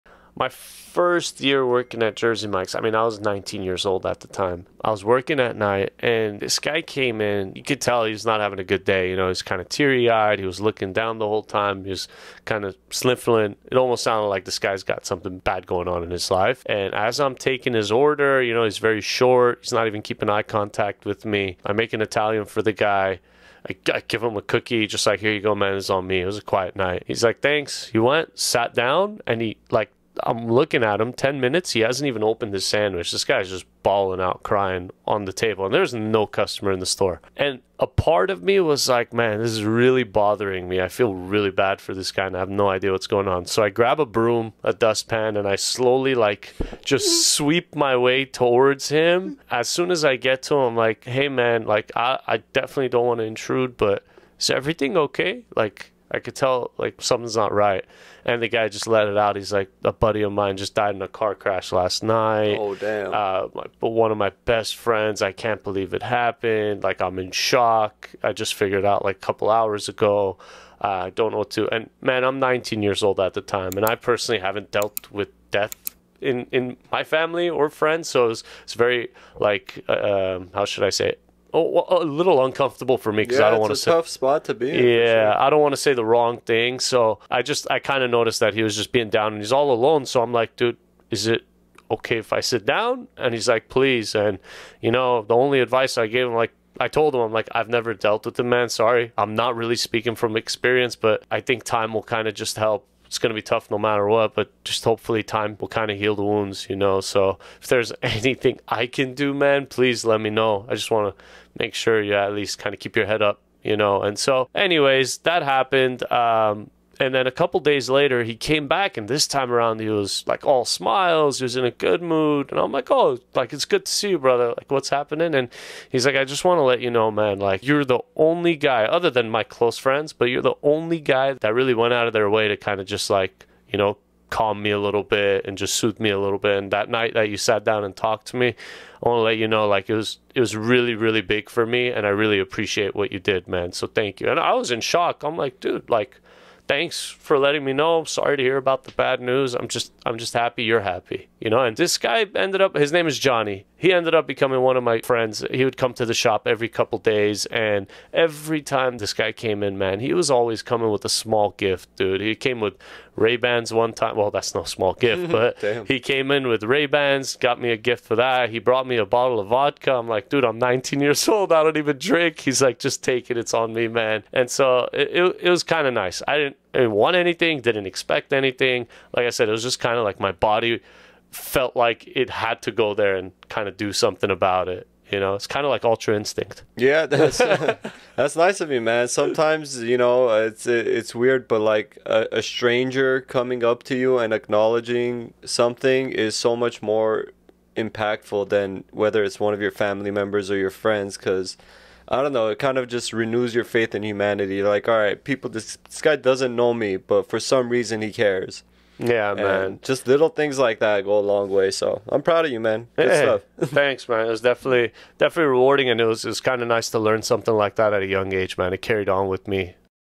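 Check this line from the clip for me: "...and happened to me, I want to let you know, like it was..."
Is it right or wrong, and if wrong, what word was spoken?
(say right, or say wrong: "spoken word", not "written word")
wrong: "talked", not "happened".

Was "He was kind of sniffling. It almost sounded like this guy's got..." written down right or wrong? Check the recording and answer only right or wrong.
right.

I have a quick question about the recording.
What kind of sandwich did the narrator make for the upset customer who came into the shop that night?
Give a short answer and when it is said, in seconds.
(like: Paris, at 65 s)
Italian, at 22 s.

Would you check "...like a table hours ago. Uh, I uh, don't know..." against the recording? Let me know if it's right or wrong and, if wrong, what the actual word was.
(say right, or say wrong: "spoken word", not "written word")
wrong: "couple", not "table".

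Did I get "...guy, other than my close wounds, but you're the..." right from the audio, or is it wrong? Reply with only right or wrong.
wrong.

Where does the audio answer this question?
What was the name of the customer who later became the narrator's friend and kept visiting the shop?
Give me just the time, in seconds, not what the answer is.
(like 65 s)
153 s.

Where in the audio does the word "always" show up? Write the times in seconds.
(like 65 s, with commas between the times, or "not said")
160 s.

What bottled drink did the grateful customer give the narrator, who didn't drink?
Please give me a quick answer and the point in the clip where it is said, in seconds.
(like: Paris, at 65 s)
Vodka, at 169 s.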